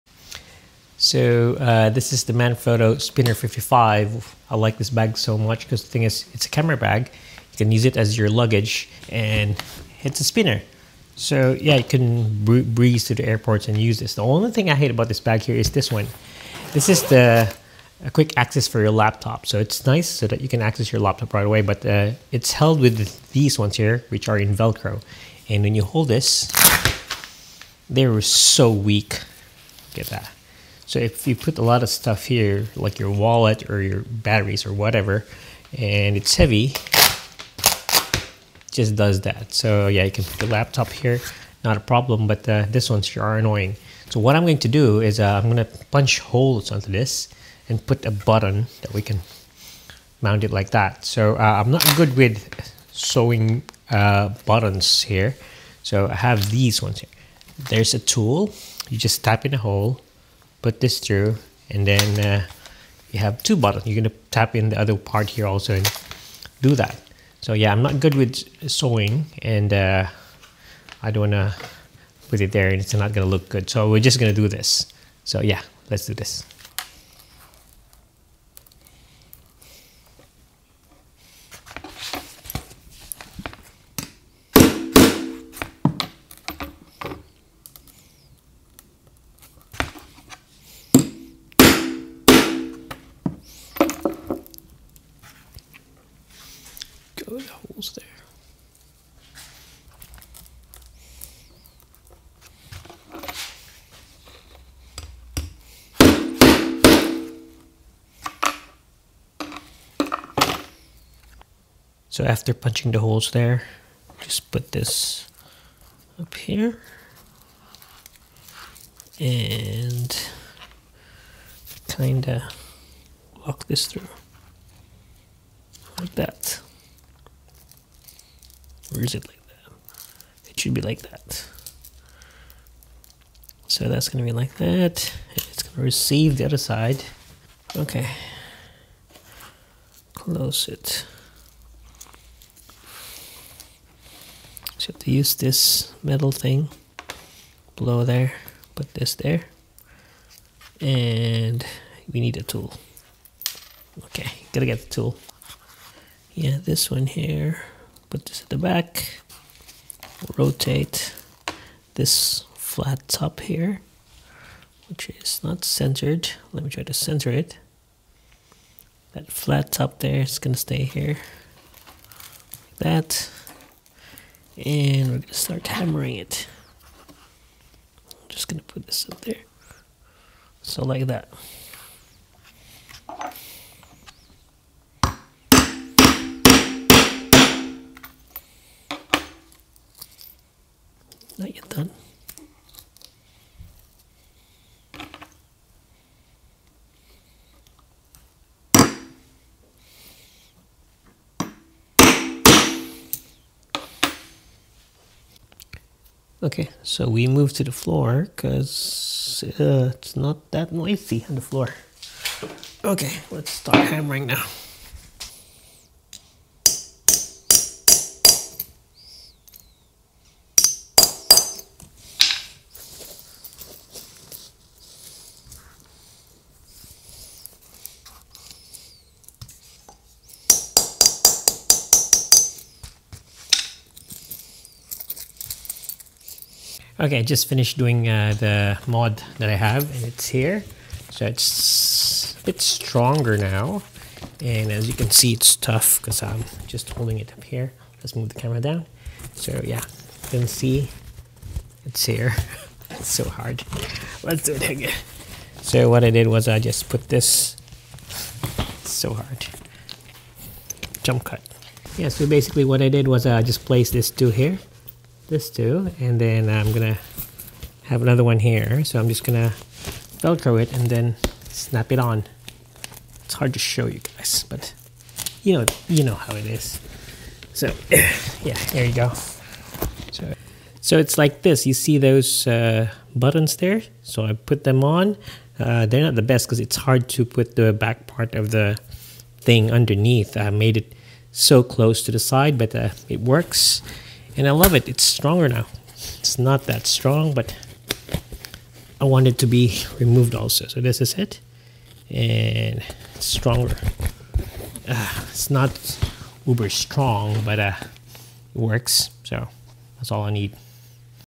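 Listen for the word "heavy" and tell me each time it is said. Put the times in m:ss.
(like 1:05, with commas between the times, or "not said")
0:36.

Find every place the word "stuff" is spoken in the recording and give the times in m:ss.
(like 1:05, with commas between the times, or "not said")
0:31.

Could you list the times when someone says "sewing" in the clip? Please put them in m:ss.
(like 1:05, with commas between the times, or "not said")
0:52, 1:08.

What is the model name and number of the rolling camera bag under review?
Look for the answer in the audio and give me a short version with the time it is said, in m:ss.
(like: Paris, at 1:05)
Manfrotto Spinner 55, at 0:02.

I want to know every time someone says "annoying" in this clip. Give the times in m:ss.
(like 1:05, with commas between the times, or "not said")
0:43.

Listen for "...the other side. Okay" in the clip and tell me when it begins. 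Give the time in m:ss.
2:16.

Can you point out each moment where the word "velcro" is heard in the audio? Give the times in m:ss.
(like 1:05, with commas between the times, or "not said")
0:24, 4:30.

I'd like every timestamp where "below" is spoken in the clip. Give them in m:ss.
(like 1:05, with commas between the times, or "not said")
2:27.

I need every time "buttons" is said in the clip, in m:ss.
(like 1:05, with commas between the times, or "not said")
0:48, 0:54, 1:03, 4:43.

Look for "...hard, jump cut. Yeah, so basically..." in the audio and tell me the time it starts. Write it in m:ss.
4:19.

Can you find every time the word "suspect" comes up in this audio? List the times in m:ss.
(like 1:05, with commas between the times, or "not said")
not said.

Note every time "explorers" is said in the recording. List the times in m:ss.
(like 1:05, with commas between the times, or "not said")
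not said.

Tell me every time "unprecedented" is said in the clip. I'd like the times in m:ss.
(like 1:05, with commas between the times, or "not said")
not said.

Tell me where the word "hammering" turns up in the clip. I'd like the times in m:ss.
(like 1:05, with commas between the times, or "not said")
2:55, 3:33.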